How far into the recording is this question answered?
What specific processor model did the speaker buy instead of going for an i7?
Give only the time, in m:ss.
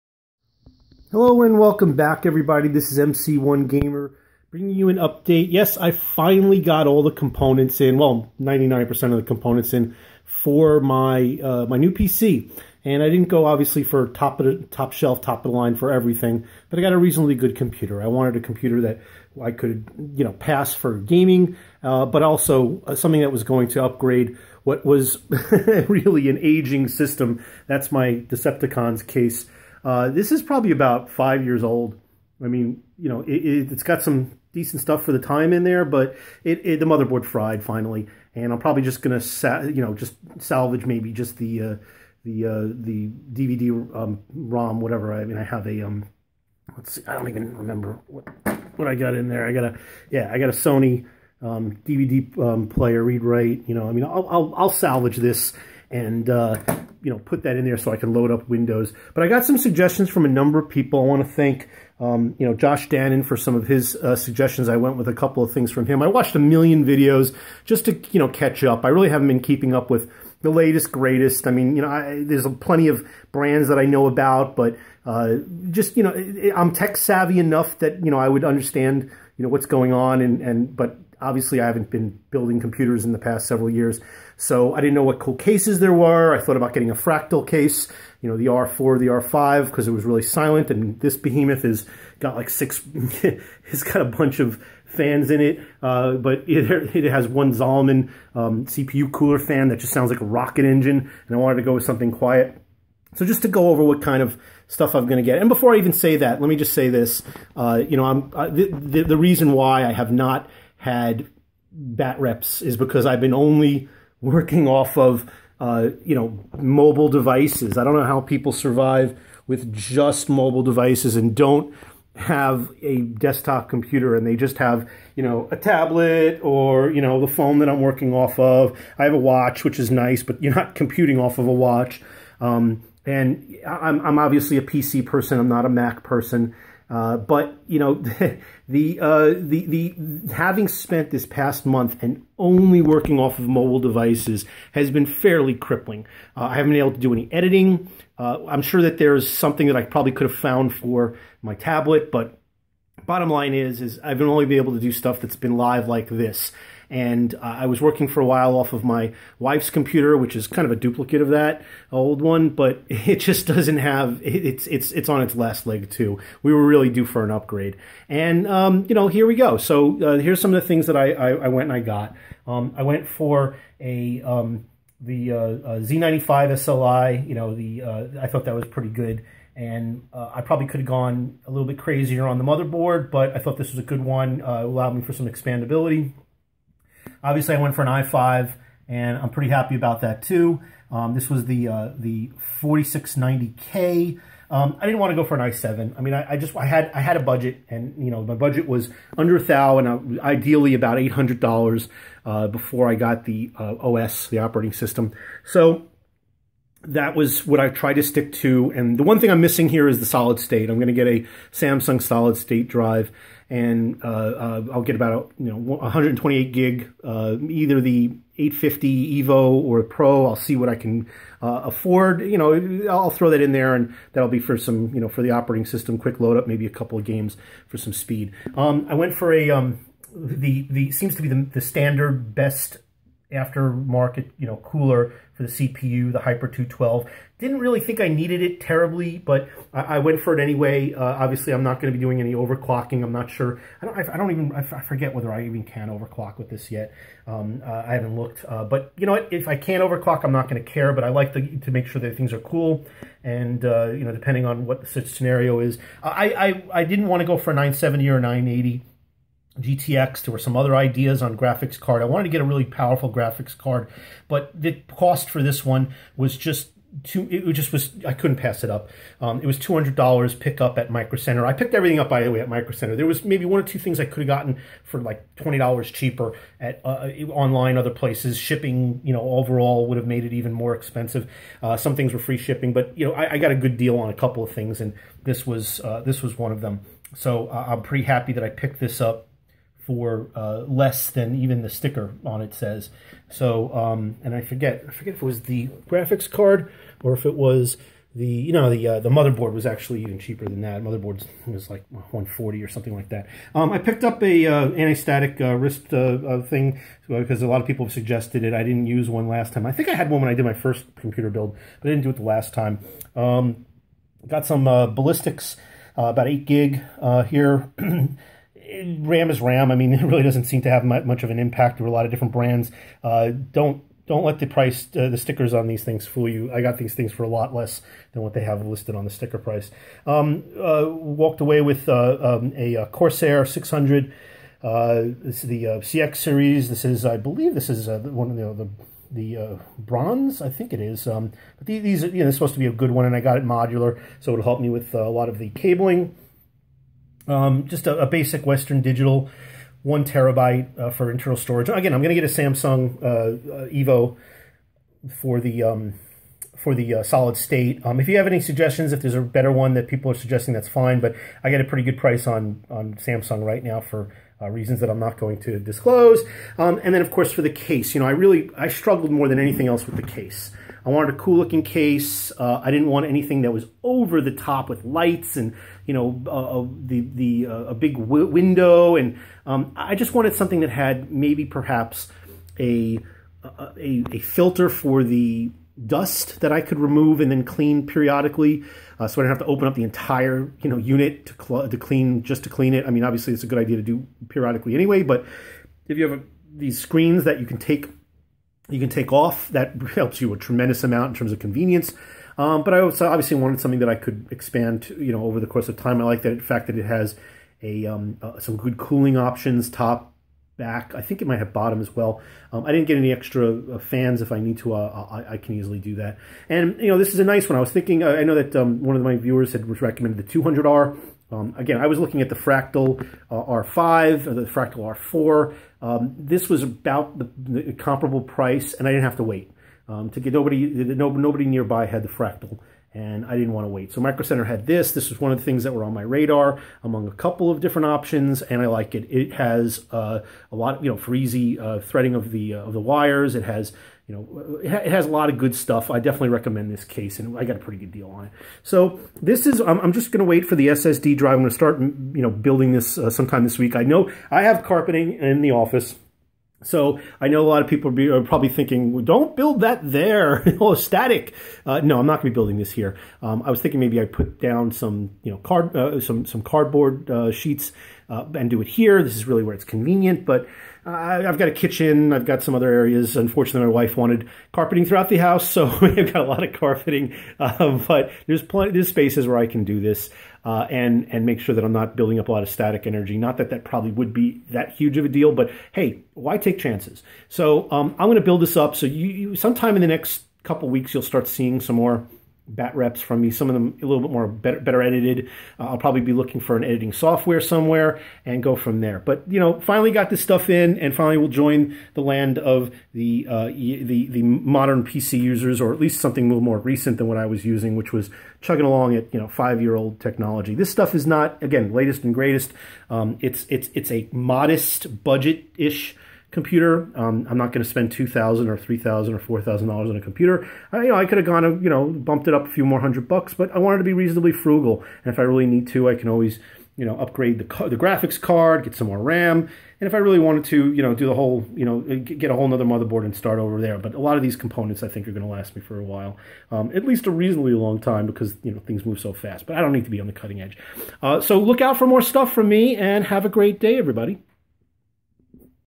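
3:12.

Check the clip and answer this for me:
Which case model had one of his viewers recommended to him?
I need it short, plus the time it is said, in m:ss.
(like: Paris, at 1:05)
200R, at 7:00.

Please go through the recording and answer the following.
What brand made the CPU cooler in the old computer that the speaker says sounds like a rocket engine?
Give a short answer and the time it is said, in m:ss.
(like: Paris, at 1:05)
Zalman, at 1:37.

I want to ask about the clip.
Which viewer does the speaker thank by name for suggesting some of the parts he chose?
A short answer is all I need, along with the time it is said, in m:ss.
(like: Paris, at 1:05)
Josh Dannon, at 1:02.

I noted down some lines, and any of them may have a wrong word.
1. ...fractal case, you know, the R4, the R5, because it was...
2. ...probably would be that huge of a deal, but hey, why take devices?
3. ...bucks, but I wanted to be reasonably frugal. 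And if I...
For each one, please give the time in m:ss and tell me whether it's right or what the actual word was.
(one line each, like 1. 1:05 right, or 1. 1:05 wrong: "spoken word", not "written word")
1. 1:26 right
2. 8:03 wrong: "chances", not "devices"
3. 8:43 right.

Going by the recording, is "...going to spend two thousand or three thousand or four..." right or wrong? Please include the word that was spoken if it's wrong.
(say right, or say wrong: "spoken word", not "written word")
right.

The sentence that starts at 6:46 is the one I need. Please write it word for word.
I like the fact that it has a um, uh, some good cooling options, top, back.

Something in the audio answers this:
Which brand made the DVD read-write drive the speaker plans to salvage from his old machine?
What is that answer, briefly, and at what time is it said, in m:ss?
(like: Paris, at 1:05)
Sony, at 0:50.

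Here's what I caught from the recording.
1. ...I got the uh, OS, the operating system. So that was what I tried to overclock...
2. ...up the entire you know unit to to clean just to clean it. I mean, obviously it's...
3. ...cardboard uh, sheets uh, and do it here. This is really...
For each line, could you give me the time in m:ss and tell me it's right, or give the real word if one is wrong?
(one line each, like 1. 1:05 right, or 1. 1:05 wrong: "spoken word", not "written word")
1. 3:22 wrong: "stick", not "overclock"
2. 6:29 right
3. 7:46 right.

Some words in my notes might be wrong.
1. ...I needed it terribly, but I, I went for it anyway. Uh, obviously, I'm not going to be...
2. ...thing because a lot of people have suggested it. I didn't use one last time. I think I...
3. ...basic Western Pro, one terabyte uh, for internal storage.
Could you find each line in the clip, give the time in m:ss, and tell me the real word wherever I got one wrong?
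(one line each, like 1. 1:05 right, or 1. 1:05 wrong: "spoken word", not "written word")
1. 3:57 right
2. 5:06 right
3. 5:48 wrong: "Digital", not "Pro".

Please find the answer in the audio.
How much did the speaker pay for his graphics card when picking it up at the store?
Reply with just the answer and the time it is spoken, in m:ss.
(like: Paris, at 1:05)
$200, at 4:29.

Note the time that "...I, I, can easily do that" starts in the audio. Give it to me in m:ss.
6:55.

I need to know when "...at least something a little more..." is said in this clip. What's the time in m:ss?
8:25.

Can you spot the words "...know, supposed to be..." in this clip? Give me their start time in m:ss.
5:42.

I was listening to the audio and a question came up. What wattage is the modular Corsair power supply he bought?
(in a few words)
600.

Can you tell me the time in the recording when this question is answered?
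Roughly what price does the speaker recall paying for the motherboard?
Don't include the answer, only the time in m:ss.
5:01.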